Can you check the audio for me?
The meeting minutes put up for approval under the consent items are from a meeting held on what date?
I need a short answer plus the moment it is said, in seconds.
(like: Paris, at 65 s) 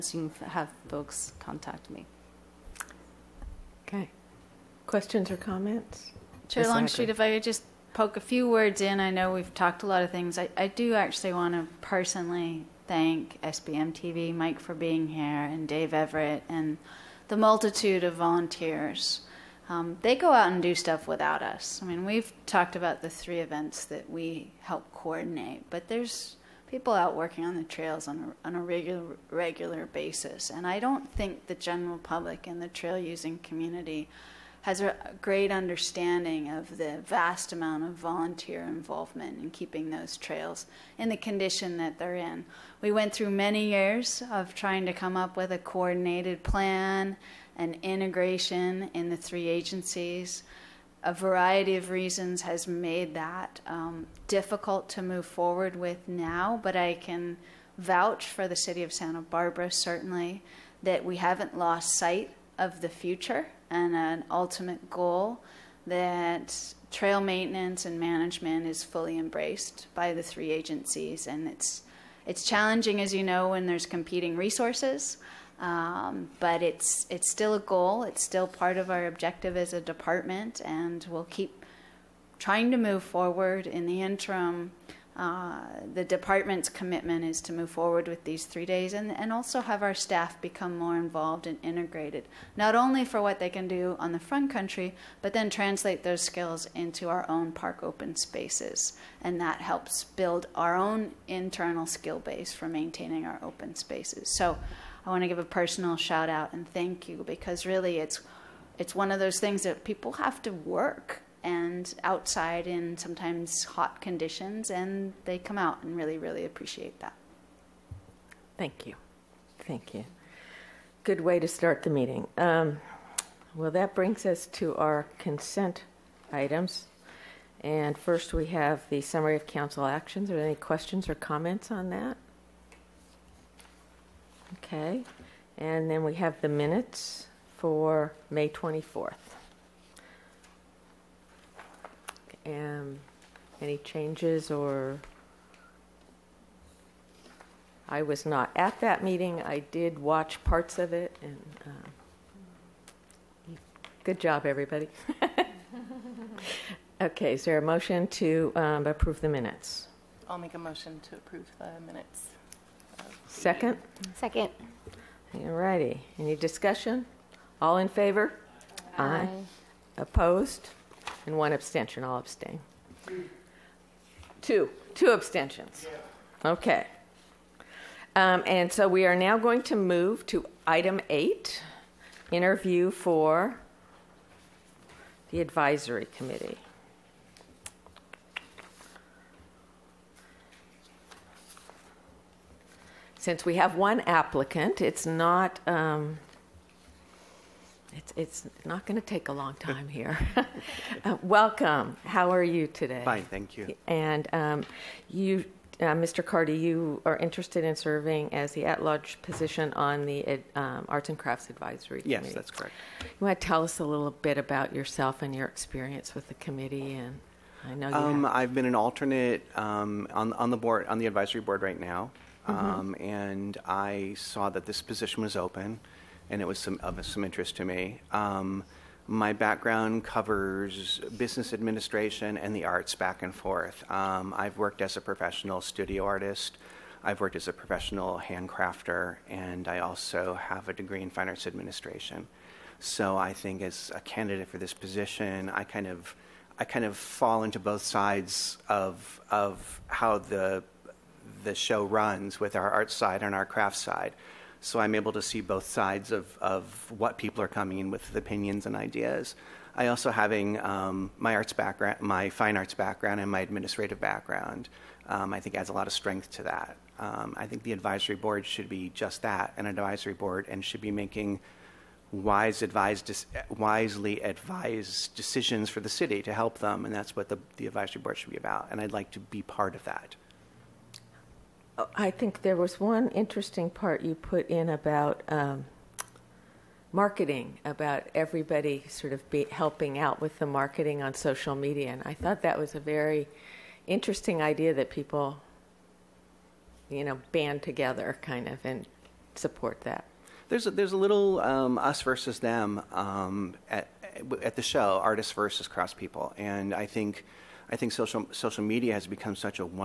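May 24th, at 138 s.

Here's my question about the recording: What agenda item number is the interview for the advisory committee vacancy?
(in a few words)
8.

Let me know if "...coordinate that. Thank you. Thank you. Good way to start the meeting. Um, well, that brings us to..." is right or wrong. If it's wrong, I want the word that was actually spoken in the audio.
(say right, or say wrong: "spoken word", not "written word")
wrong: "appreciate", not "coordinate".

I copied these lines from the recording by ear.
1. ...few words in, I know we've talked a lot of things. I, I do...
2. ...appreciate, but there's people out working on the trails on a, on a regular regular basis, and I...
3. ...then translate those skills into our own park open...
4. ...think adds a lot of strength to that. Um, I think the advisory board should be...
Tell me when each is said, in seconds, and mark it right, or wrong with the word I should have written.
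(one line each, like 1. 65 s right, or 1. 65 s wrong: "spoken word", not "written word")
1. 8 s right
2. 24 s wrong: "coordinate", not "appreciate"
3. 95 s right
4. 265 s right.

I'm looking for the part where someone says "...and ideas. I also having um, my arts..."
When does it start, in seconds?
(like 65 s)
258 s.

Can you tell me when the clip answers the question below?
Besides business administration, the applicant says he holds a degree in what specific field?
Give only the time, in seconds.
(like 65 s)
241 s.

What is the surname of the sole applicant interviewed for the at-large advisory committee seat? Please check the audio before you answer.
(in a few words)
Carty.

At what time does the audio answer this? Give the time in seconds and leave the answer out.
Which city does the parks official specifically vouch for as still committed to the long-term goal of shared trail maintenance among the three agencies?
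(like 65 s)
58 s.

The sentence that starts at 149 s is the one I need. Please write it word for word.
I did watch parts of it, and um, good job, everybody.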